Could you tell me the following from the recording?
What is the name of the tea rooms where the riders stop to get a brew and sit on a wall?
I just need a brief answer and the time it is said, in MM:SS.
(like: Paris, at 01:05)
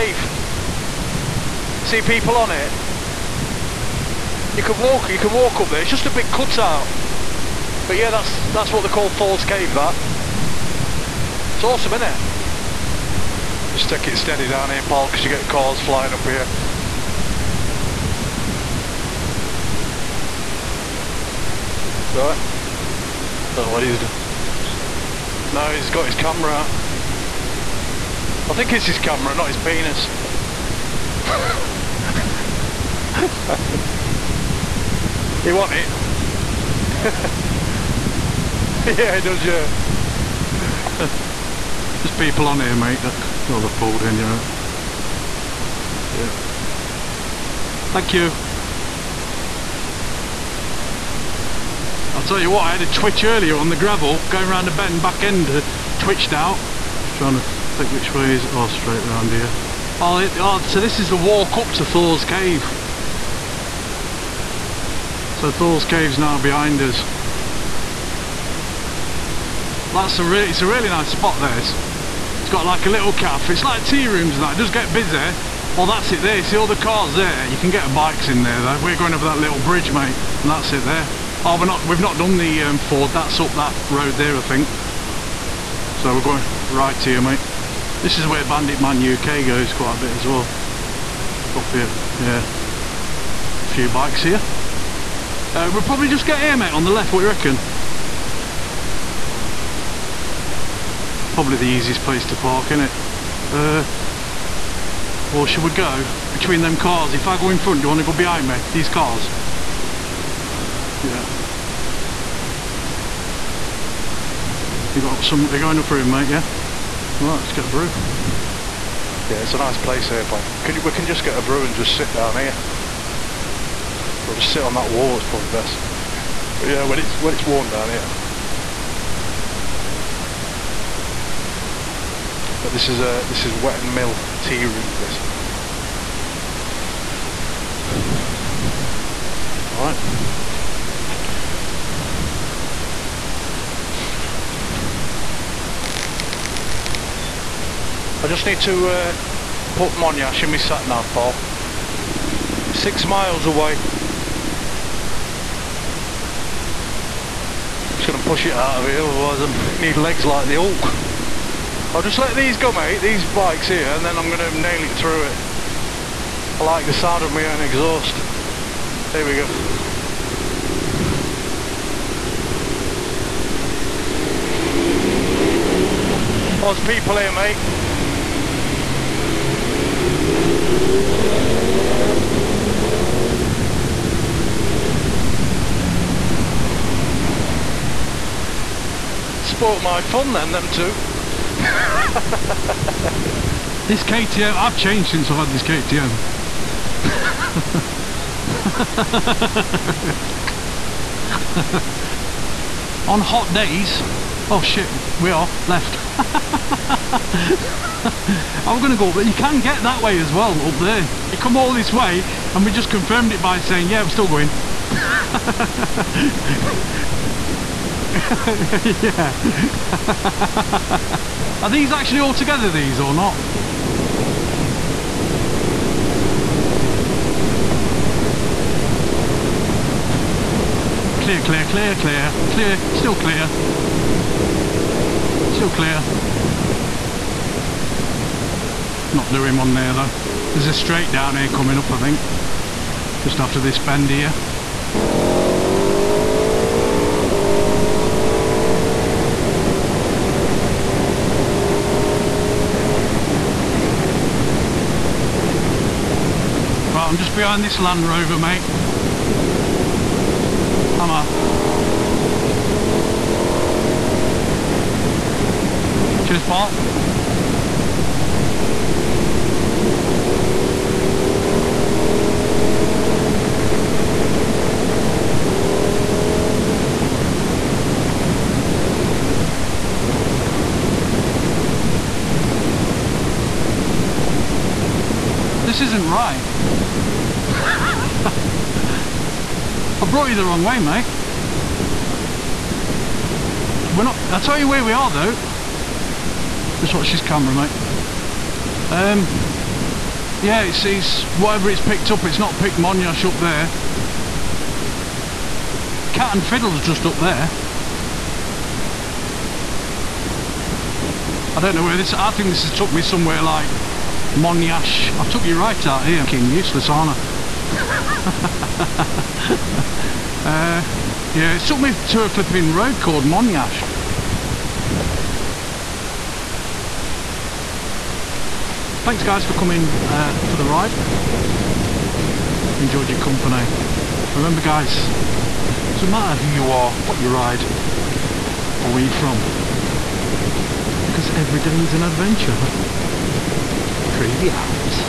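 Wetton Mill tea rooms, at 02:13.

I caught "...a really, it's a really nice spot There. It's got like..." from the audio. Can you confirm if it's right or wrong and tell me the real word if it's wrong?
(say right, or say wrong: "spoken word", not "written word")
right.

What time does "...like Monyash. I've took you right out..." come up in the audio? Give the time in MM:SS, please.
05:13.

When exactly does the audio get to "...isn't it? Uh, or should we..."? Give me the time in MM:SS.
01:42.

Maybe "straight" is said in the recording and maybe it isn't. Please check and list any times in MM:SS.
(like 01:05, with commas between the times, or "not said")
00:58, 04:00.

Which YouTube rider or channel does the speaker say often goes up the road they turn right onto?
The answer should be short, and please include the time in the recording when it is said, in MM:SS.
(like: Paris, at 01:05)
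Bandit Man UK, at 01:28.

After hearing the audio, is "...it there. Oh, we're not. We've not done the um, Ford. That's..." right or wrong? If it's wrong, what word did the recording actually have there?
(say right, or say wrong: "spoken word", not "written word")
right.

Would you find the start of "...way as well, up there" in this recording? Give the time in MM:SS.
03:30.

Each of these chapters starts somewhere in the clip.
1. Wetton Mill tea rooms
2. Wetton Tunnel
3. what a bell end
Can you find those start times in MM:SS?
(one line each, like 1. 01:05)
1. 01:43
2. 02:46
3. 05:21.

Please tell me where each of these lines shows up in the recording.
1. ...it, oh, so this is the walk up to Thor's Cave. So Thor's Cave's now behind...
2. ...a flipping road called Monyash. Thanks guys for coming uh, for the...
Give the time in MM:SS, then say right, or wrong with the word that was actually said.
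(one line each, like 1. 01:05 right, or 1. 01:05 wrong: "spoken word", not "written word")
1. 01:00 right
2. 05:22 right.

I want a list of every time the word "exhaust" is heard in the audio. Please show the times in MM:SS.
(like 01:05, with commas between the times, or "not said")
02:47.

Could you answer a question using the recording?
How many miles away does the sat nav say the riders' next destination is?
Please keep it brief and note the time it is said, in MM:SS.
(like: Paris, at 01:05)
6, at 02:32.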